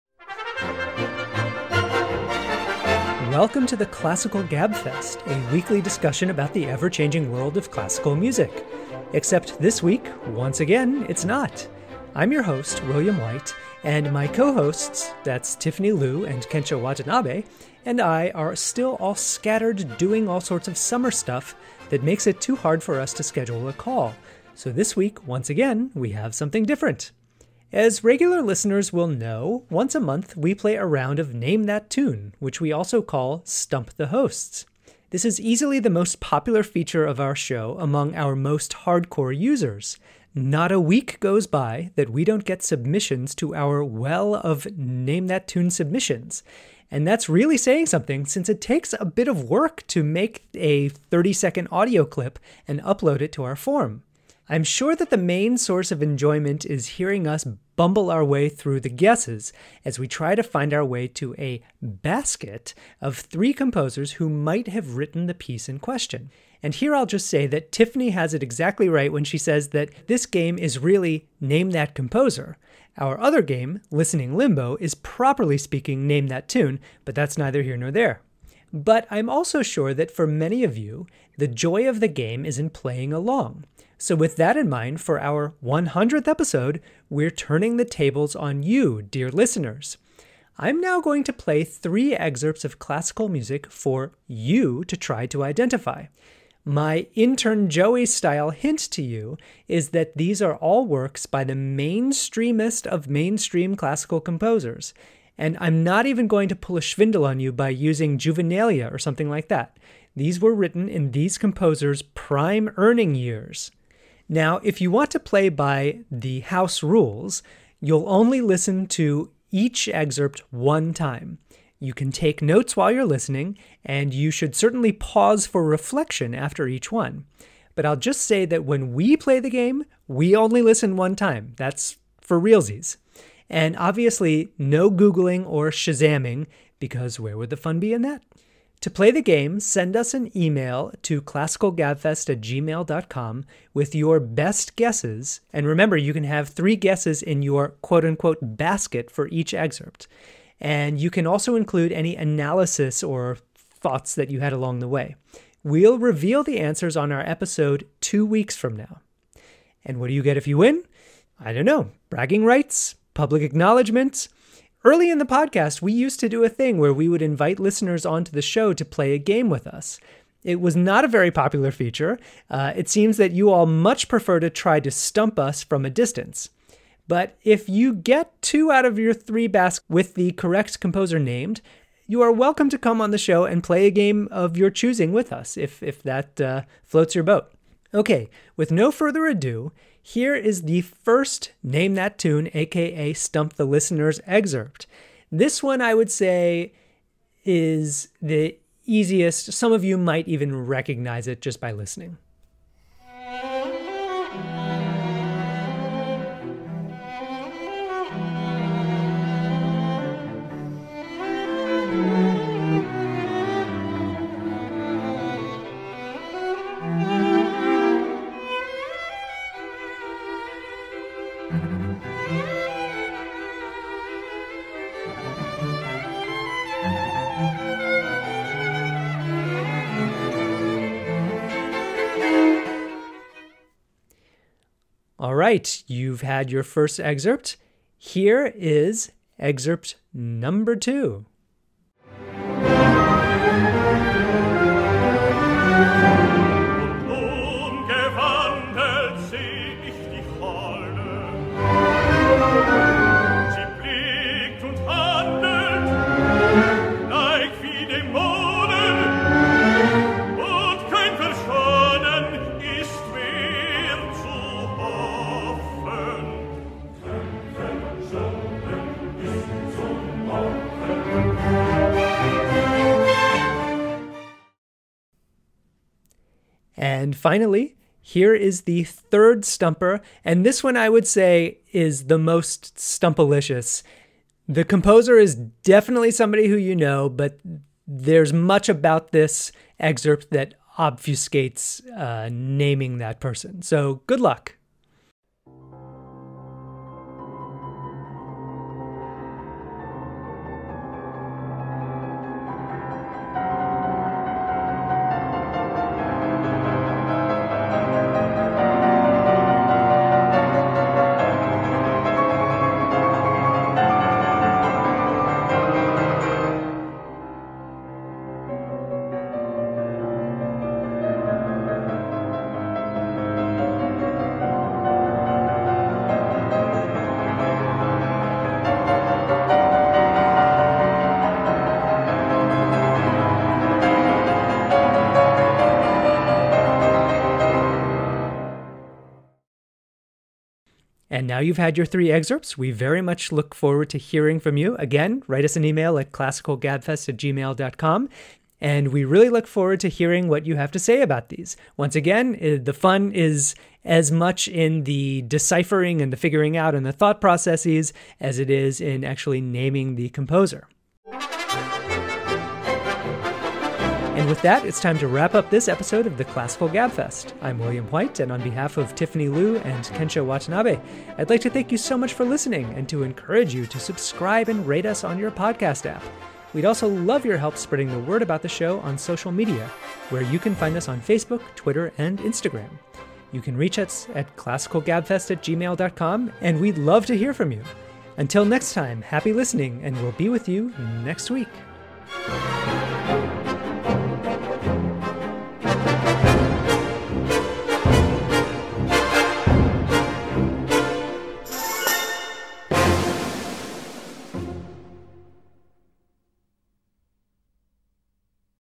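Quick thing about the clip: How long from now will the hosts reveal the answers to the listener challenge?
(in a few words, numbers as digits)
two weeks.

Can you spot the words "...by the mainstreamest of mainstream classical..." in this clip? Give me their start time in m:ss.
1:41.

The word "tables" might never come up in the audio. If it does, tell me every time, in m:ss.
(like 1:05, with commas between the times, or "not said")
1:27.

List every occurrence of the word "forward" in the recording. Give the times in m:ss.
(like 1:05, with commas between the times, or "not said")
5:43, 5:49.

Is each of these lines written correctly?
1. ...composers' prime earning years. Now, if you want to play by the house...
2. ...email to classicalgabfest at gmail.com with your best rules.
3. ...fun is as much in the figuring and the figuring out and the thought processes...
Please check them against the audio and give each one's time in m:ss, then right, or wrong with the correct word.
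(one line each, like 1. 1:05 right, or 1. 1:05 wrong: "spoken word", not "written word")
1. 1:51 right
2. 2:20 wrong: "guesses", not "rules"
3. 5:52 wrong: "deciphering", not "figuring".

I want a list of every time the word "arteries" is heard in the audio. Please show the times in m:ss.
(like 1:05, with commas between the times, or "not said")
not said.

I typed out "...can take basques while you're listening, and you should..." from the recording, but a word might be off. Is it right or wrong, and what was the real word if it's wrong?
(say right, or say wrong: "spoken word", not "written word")
wrong: "notes", not "basques".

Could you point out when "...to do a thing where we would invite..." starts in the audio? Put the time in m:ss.
2:46.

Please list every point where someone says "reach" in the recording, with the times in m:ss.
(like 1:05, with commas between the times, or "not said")
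6:23.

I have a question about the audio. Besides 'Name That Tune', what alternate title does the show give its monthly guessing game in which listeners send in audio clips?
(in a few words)
Stump the Hosts.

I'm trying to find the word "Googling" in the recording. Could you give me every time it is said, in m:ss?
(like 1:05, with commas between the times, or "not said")
2:14.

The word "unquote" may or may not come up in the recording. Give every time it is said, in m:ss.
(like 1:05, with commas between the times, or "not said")
2:28.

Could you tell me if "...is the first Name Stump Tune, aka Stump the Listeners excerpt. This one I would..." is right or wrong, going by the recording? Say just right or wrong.
wrong.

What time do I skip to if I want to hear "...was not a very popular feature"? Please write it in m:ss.
2:50.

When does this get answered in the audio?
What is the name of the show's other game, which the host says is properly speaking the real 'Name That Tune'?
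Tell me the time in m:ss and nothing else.
1:13.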